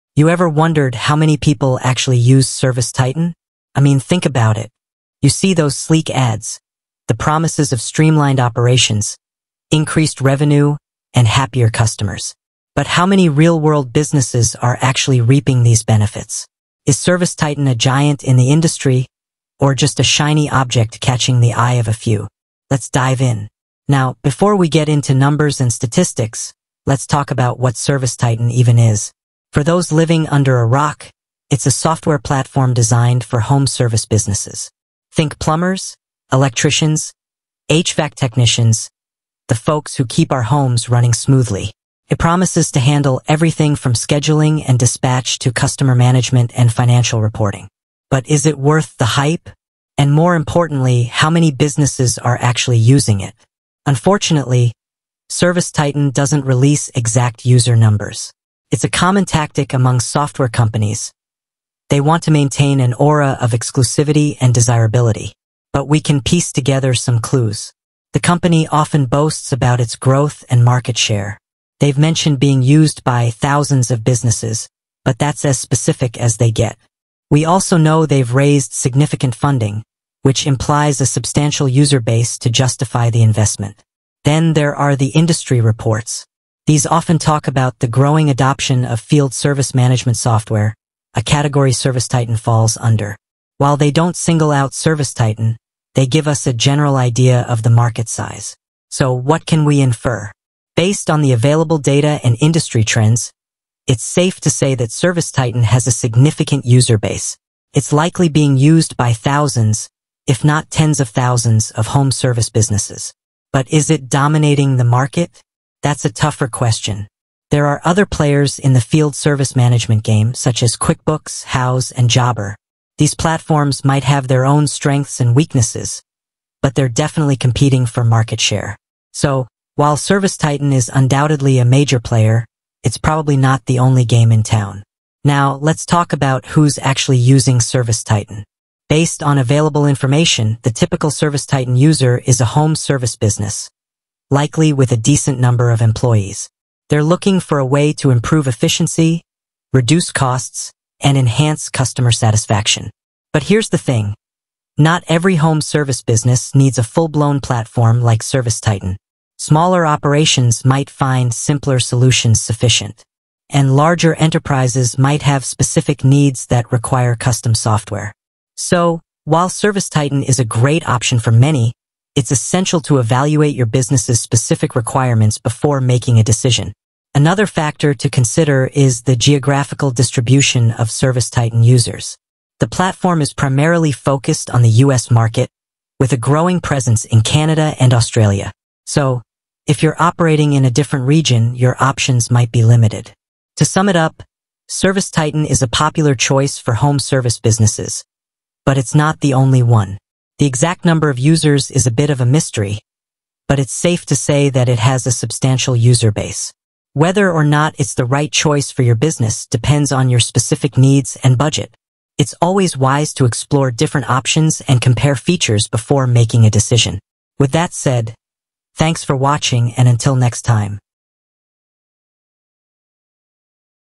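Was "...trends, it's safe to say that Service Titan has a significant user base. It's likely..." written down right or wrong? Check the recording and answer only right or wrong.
right.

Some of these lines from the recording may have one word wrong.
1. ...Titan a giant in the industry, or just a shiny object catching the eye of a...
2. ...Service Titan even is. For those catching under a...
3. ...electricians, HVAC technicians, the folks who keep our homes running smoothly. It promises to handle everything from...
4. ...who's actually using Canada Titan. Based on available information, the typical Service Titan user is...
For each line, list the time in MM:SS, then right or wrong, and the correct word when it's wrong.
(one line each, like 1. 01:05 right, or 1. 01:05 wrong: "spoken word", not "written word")
1. 00:17 right
2. 00:27 wrong: "living", not "catching"
3. 00:36 right
4. 02:16 wrong: "Service", not "Canada".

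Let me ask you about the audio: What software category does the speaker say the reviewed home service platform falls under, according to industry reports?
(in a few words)
field service management software.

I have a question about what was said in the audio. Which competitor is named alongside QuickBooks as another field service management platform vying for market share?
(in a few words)
Jobber.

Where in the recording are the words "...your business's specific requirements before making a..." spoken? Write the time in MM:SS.
02:53.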